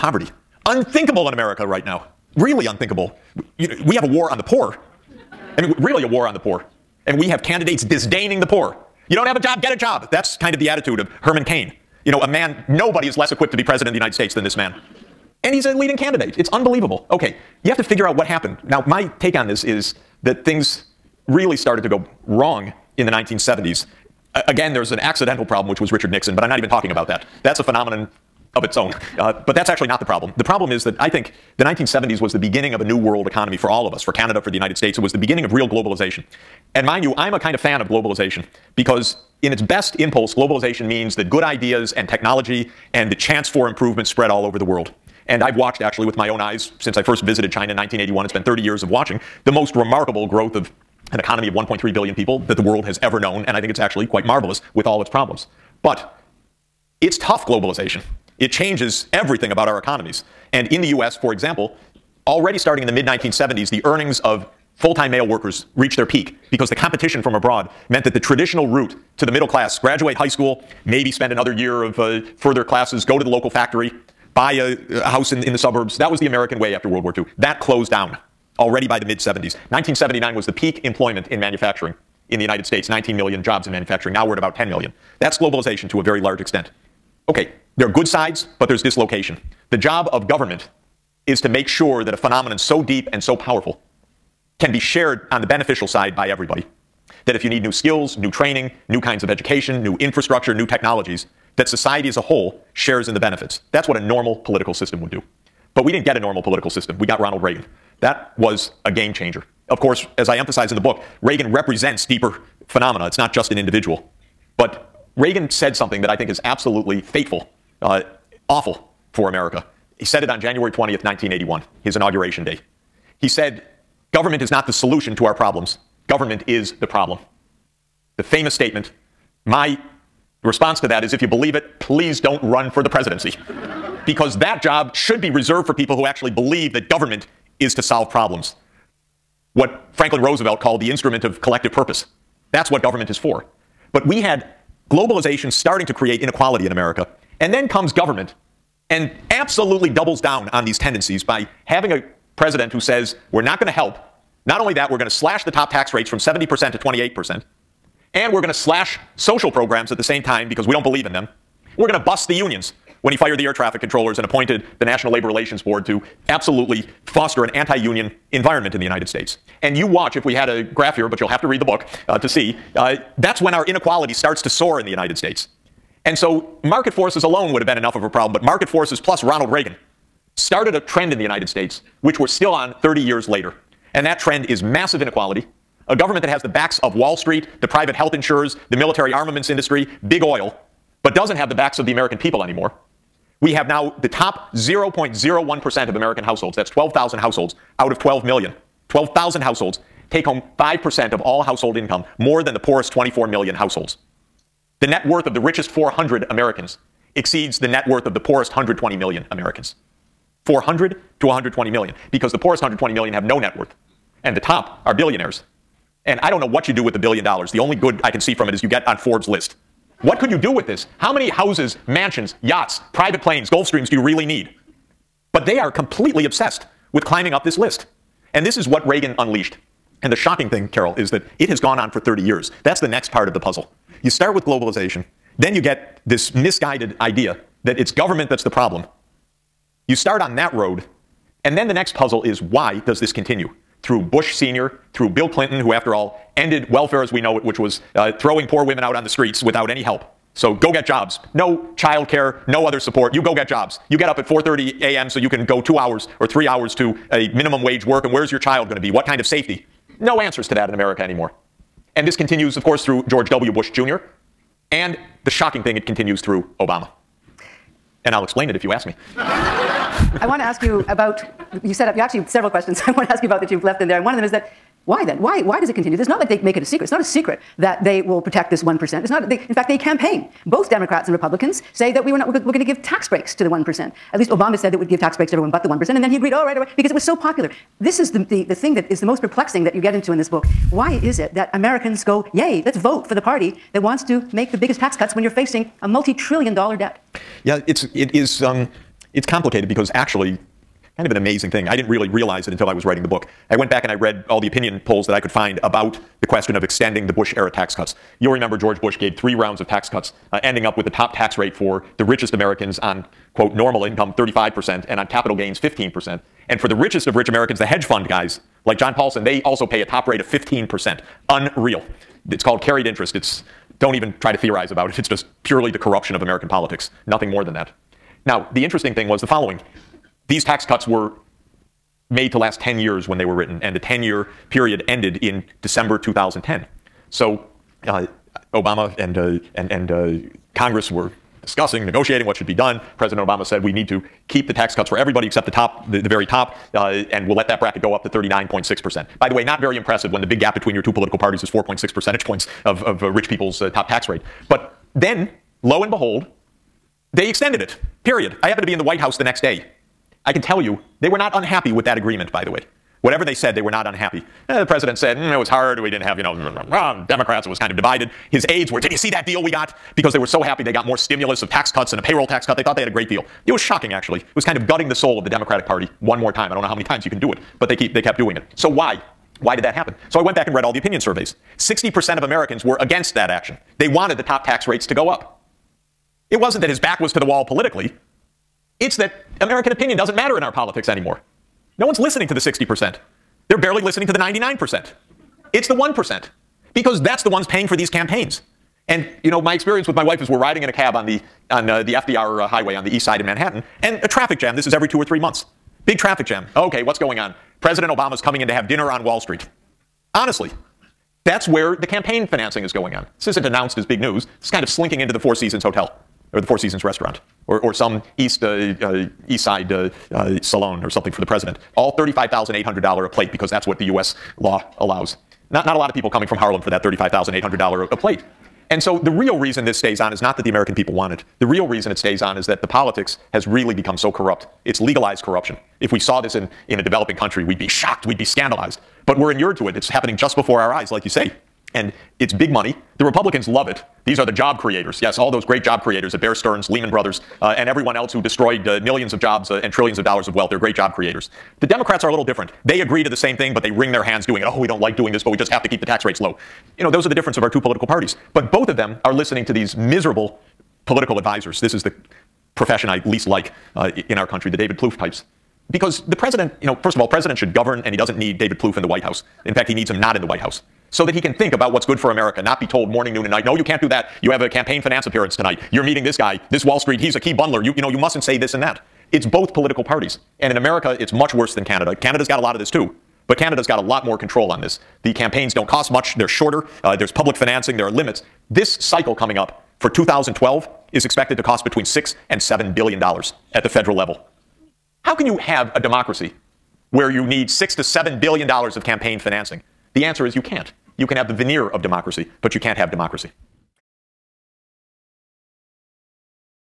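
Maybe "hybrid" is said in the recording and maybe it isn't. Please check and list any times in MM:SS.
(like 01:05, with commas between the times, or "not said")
not said.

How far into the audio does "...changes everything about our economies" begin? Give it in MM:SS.
00:58.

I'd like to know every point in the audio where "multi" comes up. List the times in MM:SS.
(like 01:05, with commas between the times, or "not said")
04:55.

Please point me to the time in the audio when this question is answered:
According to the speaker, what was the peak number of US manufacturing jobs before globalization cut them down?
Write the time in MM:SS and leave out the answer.
01:22.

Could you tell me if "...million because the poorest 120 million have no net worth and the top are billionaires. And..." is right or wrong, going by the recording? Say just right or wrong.
right.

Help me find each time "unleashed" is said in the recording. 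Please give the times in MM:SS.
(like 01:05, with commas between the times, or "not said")
03:49.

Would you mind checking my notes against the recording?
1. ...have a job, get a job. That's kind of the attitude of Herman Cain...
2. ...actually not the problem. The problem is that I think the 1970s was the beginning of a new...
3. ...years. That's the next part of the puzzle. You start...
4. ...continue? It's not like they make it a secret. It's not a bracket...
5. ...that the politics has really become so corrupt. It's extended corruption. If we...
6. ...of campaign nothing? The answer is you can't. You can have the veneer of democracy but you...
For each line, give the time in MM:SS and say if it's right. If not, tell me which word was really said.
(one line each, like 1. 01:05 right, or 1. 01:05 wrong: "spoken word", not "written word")
1. 00:09 right
2. 00:29 right
3. 03:52 right
4. 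04:35 wrong: "secret", not "bracket"
5. 07:12 wrong: "legalized", not "extended"
6. 08:18 wrong: "financing", not "nothing".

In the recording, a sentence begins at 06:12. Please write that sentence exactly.
They thought they had a great deal.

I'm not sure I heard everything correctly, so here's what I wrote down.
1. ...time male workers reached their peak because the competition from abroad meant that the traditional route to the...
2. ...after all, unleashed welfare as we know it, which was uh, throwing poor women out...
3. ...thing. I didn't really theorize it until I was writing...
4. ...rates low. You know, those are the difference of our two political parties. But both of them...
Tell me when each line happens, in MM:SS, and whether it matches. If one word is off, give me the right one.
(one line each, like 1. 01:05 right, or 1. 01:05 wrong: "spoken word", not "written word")
1. 01:04 right
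2. 04:05 wrong: "ended", not "unleashed"
3. 05:01 wrong: "realize", not "theorize"
4. 07:36 right.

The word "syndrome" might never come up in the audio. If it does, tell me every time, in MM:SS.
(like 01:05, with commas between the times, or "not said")
not said.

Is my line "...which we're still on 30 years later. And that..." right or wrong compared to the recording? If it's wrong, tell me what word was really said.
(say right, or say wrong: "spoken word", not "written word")
right.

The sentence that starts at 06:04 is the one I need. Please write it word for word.
Eh, the president said, mm, it was hard, we didn't have, you know, Democrats, it was kind of divided.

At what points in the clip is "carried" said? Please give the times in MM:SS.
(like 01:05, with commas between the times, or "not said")
05:22.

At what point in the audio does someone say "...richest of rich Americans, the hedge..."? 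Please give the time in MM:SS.
05:16.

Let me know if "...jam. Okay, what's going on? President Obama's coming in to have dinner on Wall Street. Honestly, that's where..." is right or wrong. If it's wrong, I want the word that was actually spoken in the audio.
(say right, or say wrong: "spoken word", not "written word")
right.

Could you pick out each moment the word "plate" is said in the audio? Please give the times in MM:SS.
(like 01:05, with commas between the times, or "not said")
07:03, 07:07.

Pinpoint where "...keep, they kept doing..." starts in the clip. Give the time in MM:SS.
06:17.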